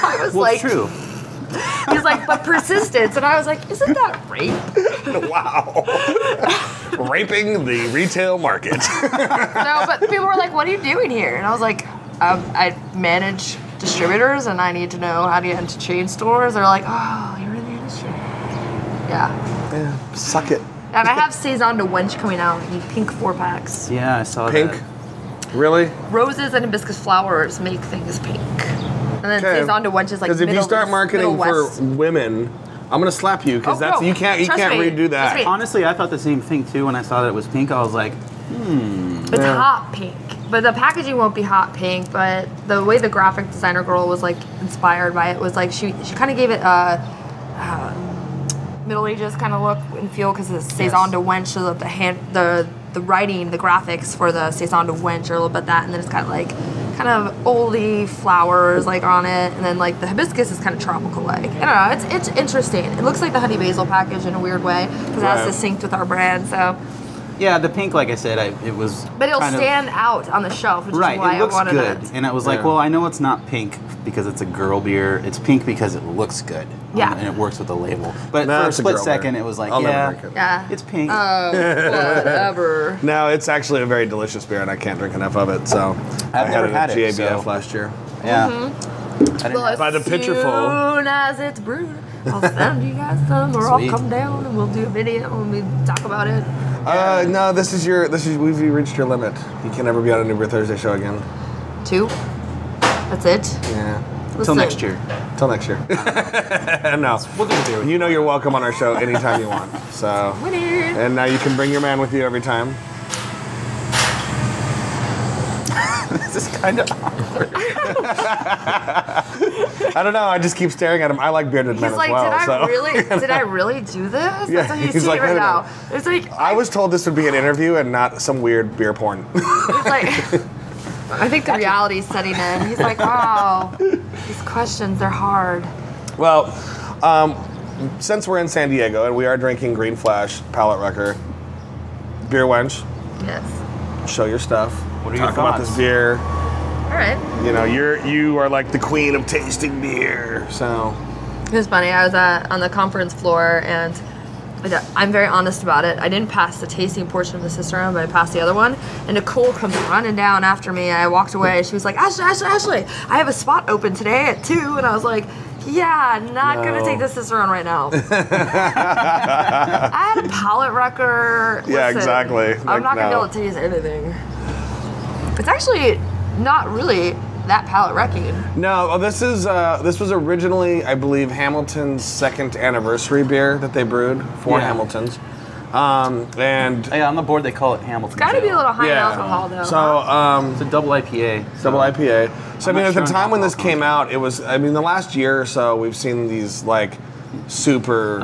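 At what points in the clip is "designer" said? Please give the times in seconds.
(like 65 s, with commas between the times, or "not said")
43 s.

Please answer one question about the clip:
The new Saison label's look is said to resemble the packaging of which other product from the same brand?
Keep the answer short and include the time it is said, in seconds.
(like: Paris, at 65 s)
honey basil, at 63 s.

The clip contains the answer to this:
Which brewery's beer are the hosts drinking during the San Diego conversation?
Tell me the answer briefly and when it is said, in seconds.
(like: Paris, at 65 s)
Green Flash, at 139 s.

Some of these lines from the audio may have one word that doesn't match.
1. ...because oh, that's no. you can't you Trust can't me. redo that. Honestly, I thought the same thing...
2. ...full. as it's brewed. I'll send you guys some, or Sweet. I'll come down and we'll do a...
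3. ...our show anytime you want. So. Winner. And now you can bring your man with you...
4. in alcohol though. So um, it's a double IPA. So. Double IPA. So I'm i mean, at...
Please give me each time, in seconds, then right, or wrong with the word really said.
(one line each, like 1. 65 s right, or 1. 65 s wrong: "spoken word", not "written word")
1. 33 s right
2. 90 s right
3. 108 s right
4. 189 s right.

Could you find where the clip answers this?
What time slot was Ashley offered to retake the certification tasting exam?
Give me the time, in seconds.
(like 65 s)
164 s.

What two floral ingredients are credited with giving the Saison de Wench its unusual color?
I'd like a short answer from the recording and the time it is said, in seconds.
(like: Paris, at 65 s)
Roses and hibiscus, at 26 s.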